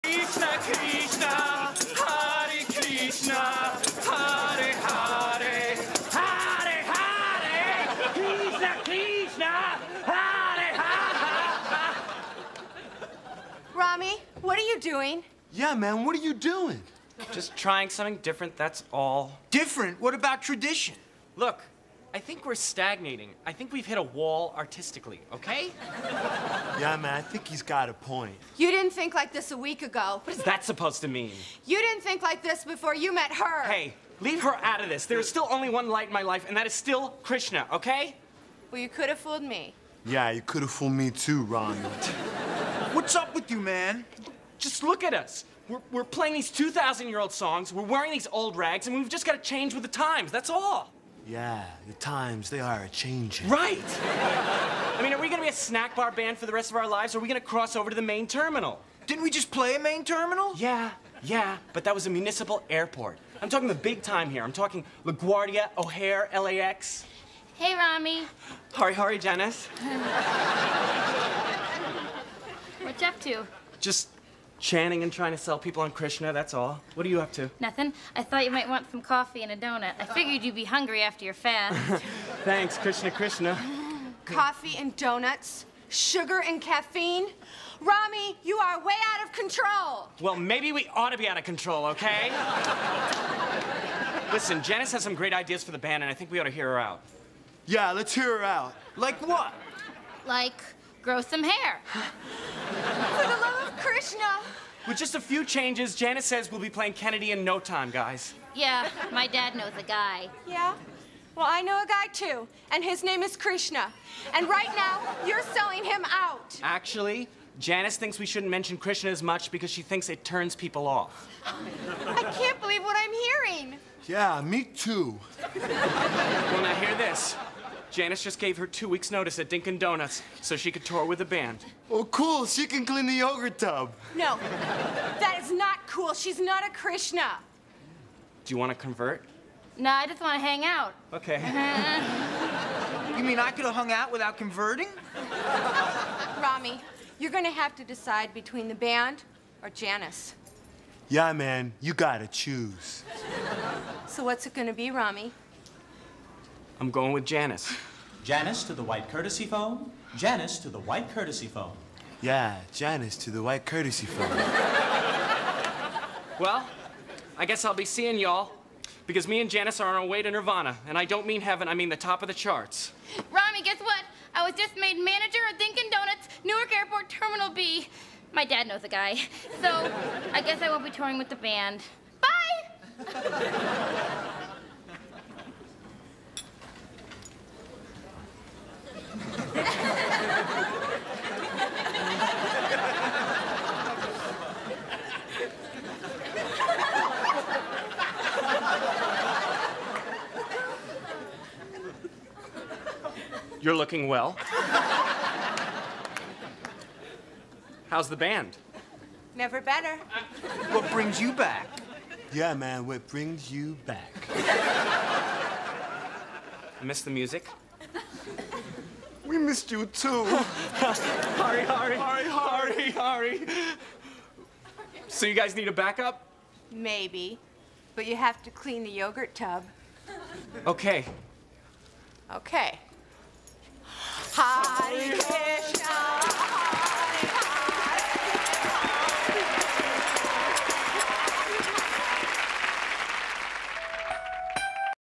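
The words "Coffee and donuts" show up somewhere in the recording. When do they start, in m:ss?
1:24.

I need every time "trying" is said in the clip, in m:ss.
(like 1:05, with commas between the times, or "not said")
0:17, 1:15.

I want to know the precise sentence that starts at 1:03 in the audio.
I'm talking the big time here.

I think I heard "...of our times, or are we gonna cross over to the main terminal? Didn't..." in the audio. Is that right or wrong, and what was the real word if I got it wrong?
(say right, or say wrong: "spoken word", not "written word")
wrong: "lives", not "times".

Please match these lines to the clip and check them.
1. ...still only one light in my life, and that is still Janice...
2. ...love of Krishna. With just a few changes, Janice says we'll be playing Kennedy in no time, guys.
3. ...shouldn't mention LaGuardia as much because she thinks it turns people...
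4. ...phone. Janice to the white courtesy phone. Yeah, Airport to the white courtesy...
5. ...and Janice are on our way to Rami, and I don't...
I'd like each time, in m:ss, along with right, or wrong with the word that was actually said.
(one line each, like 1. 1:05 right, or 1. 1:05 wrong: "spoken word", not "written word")
1. 0:35 wrong: "Krishna", not "Janice"
2. 1:43 right
3. 1:58 wrong: "Krishna", not "LaGuardia"
4. 2:39 wrong: "Janice", not "Airport"
5. 2:49 wrong: "Nirvana", not "Rami".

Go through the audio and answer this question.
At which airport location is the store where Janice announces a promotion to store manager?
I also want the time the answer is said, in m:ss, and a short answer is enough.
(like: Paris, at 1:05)
Newark Airport Terminal B, at 2:56.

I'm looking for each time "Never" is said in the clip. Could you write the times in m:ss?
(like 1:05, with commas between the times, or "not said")
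3:29.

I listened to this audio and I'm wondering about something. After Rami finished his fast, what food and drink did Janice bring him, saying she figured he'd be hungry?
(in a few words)
Coffee and a donut.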